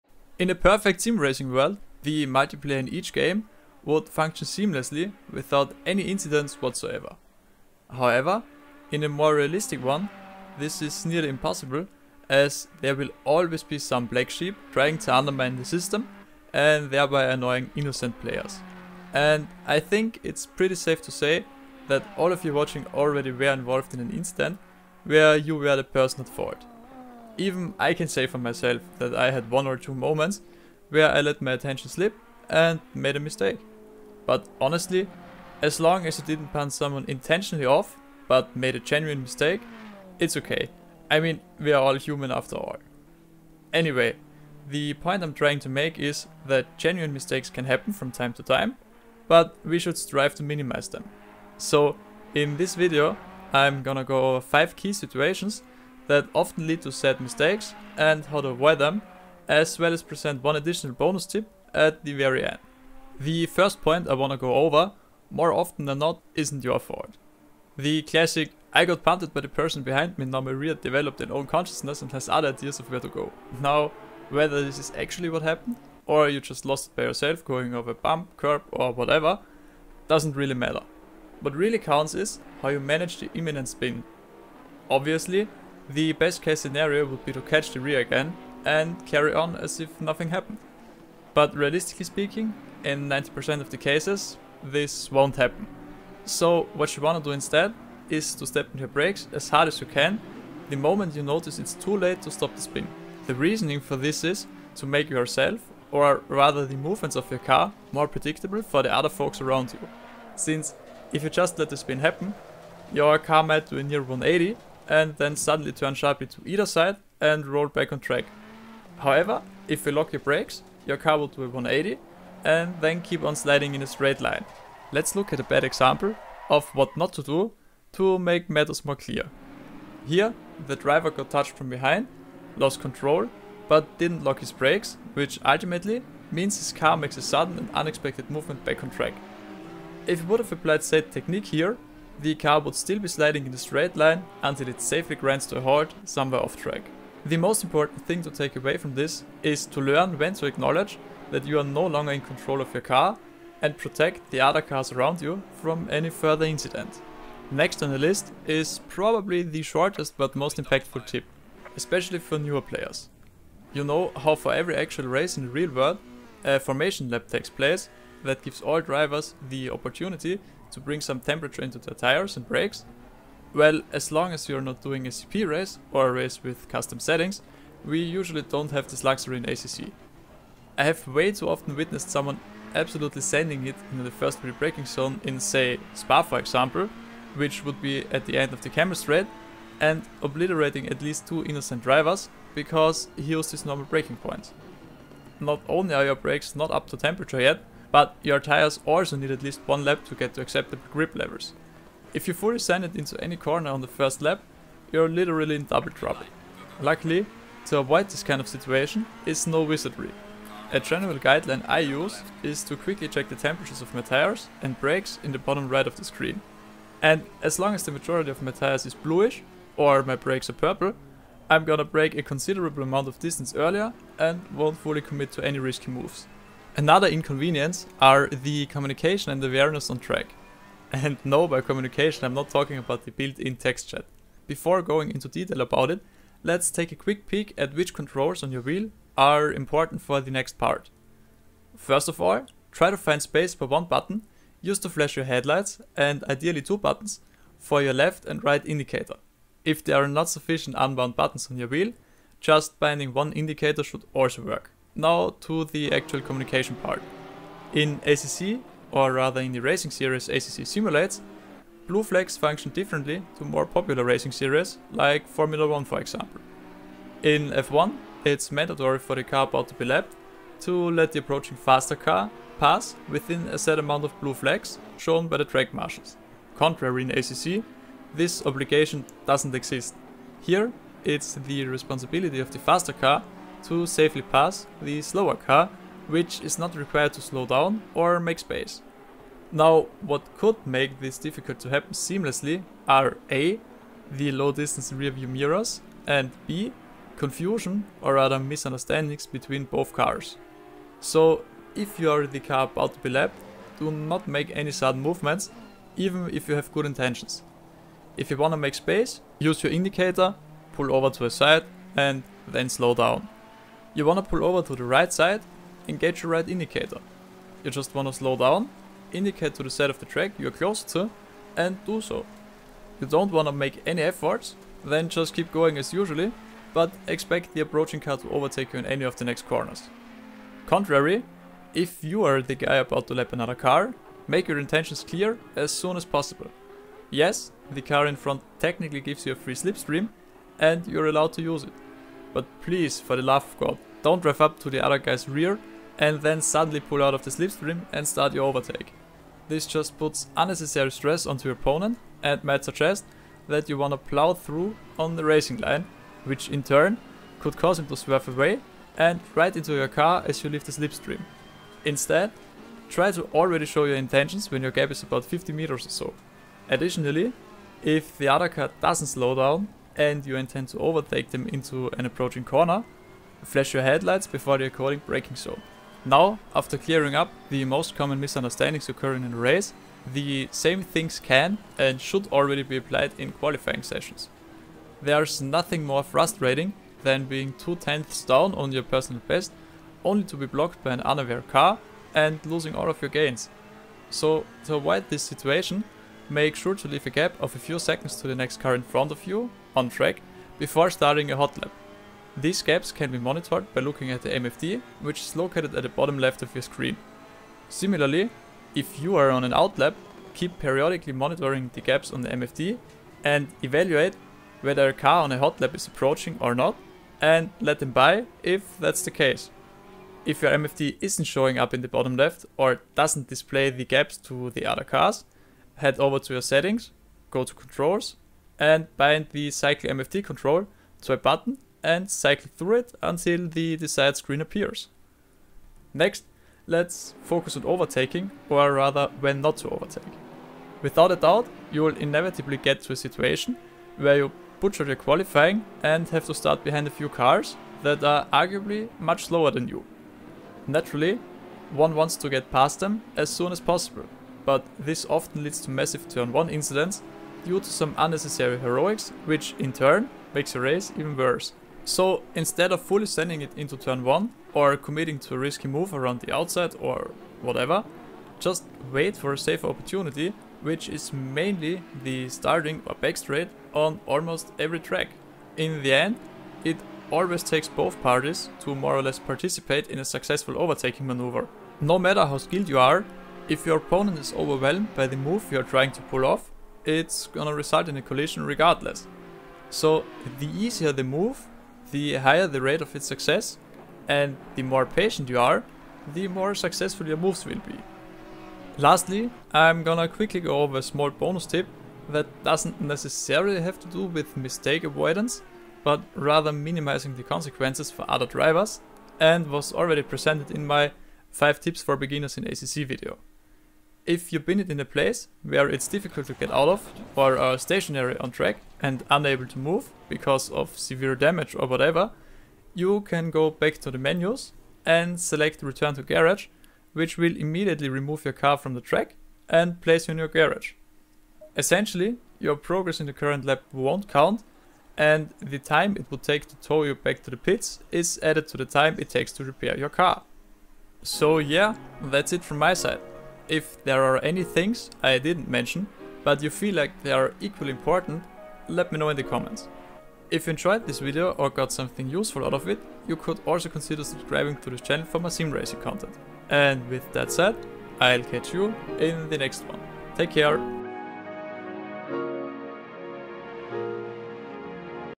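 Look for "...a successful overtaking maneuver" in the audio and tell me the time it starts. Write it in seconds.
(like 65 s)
479 s.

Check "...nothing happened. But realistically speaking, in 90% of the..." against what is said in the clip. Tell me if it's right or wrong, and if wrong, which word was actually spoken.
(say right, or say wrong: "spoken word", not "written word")
right.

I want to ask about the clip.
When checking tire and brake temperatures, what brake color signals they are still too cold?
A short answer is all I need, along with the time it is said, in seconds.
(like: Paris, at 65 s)
Purple, at 220 s.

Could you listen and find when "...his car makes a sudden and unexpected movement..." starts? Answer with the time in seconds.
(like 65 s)
136 s.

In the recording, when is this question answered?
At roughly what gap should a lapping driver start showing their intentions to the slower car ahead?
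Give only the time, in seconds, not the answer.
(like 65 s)
365 s.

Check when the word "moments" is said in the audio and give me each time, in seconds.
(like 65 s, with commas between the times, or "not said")
29 s, 100 s.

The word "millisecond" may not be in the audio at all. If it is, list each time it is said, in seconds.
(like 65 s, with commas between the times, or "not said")
not said.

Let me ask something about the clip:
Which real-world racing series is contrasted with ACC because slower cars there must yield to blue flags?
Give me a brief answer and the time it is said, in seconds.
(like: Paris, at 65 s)
Formula 1, at 265 s.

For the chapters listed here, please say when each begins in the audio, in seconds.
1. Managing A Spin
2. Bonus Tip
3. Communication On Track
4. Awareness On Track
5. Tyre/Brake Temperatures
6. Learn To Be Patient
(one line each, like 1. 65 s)
1. 62 s
2. 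497 s
3. 228 s
4. 377 s
5. 158 s
6. 439 s.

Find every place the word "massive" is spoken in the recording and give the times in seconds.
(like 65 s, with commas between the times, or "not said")
455 s.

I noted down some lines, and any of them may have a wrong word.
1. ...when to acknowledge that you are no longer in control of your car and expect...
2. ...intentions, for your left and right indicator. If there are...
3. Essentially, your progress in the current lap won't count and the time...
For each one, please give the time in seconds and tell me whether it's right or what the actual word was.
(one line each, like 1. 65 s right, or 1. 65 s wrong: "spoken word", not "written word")
1. 150 s wrong: "protect", not "expect"
2. 246 s wrong: "buttons", not "intentions"
3. 531 s right.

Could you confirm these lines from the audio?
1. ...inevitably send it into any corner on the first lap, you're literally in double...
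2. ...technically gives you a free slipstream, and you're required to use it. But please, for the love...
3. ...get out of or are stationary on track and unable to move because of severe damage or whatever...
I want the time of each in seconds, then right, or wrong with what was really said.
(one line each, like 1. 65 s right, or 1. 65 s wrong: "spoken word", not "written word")
1. 202 s wrong: "fully", not "inevitably"
2. 338 s wrong: "allowed", not "required"
3. 516 s right.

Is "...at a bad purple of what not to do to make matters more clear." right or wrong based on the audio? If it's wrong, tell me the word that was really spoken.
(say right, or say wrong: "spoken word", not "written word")
wrong: "example", not "purple".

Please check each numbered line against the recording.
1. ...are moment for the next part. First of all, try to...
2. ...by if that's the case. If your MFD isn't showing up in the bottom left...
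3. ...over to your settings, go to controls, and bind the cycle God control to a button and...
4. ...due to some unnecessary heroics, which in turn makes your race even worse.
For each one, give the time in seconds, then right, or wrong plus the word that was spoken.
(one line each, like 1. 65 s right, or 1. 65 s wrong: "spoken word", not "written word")
1. 239 s wrong: "important", not "moment"
2. 417 s right
3. 425 s wrong: "MFD", not "God"
4. 457 s right.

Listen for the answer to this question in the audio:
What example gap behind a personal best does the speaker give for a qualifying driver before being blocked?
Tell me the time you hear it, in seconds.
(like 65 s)
387 s.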